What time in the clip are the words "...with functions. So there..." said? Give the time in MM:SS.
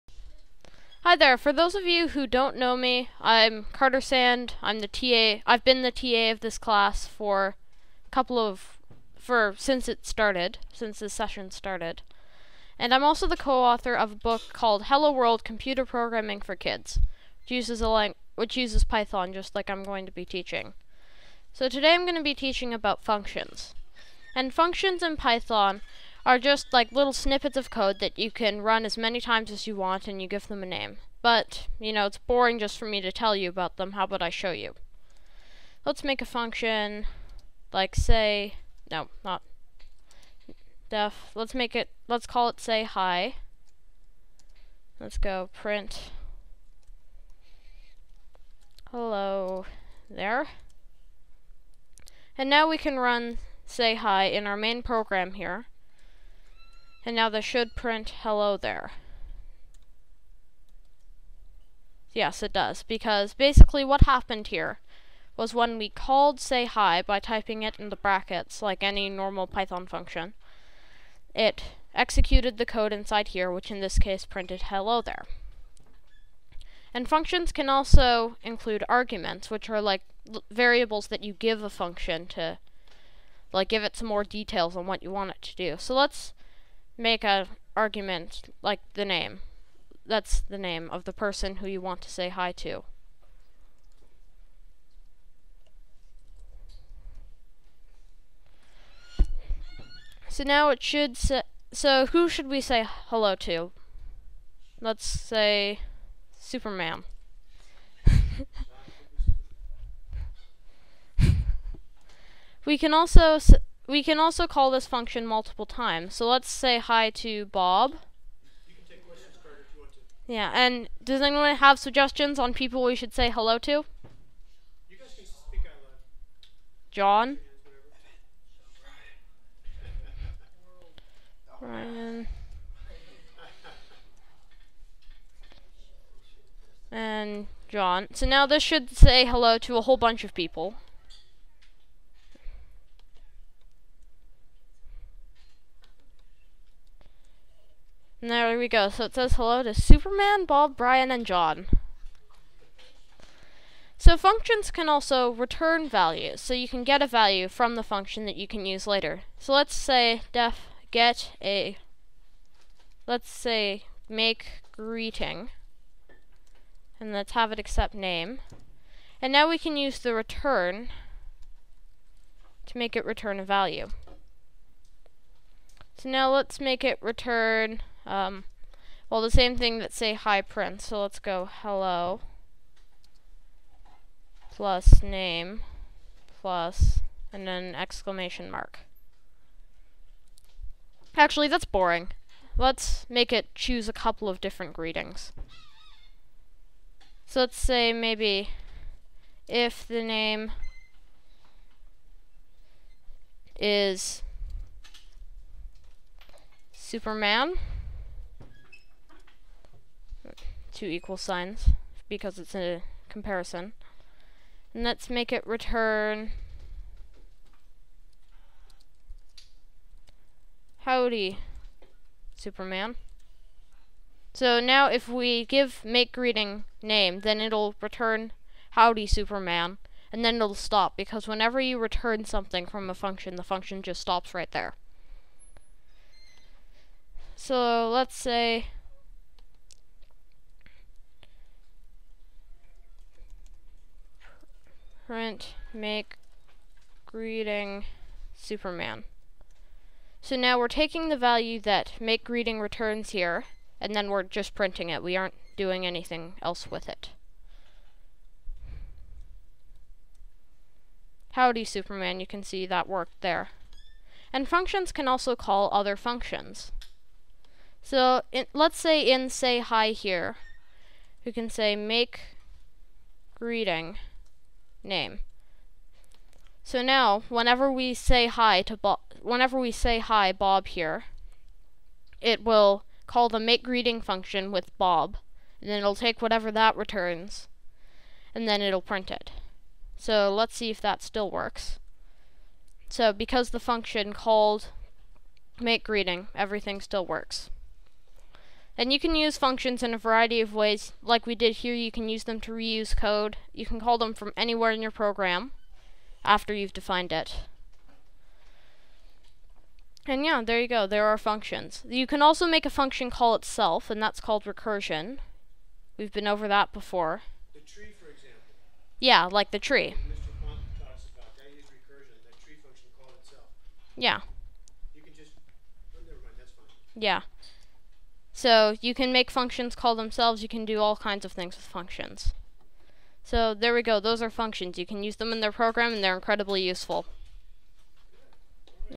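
05:31.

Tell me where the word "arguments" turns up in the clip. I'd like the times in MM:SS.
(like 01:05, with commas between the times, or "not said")
01:18, 01:27.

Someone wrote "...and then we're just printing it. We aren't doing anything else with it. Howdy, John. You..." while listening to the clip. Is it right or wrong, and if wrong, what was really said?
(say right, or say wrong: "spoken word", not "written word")
wrong: "Superman", not "John".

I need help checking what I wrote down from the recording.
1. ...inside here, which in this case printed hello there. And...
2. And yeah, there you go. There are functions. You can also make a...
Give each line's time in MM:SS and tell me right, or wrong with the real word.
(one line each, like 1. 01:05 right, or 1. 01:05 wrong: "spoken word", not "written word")
1. 01:12 right
2. 05:10 right.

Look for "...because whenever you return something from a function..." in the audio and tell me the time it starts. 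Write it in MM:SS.
03:50.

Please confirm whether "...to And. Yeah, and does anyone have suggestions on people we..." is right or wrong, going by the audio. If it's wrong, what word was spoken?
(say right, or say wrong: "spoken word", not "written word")
wrong: "Bob", not "And".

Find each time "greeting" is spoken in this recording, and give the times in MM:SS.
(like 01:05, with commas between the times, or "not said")
02:44, 03:14, 03:46, 04:07, 04:12, 04:33, 04:43, 04:55.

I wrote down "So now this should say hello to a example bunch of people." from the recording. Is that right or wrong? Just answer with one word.
wrong.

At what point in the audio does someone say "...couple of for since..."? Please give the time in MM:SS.
00:08.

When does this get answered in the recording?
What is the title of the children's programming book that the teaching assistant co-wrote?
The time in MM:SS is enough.
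00:14.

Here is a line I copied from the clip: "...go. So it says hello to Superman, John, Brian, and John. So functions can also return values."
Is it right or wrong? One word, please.
wrong.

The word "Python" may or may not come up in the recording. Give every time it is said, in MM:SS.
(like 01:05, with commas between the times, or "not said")
00:18, 00:25, 01:09.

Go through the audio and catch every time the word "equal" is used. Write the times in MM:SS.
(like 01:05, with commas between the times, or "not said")
03:30.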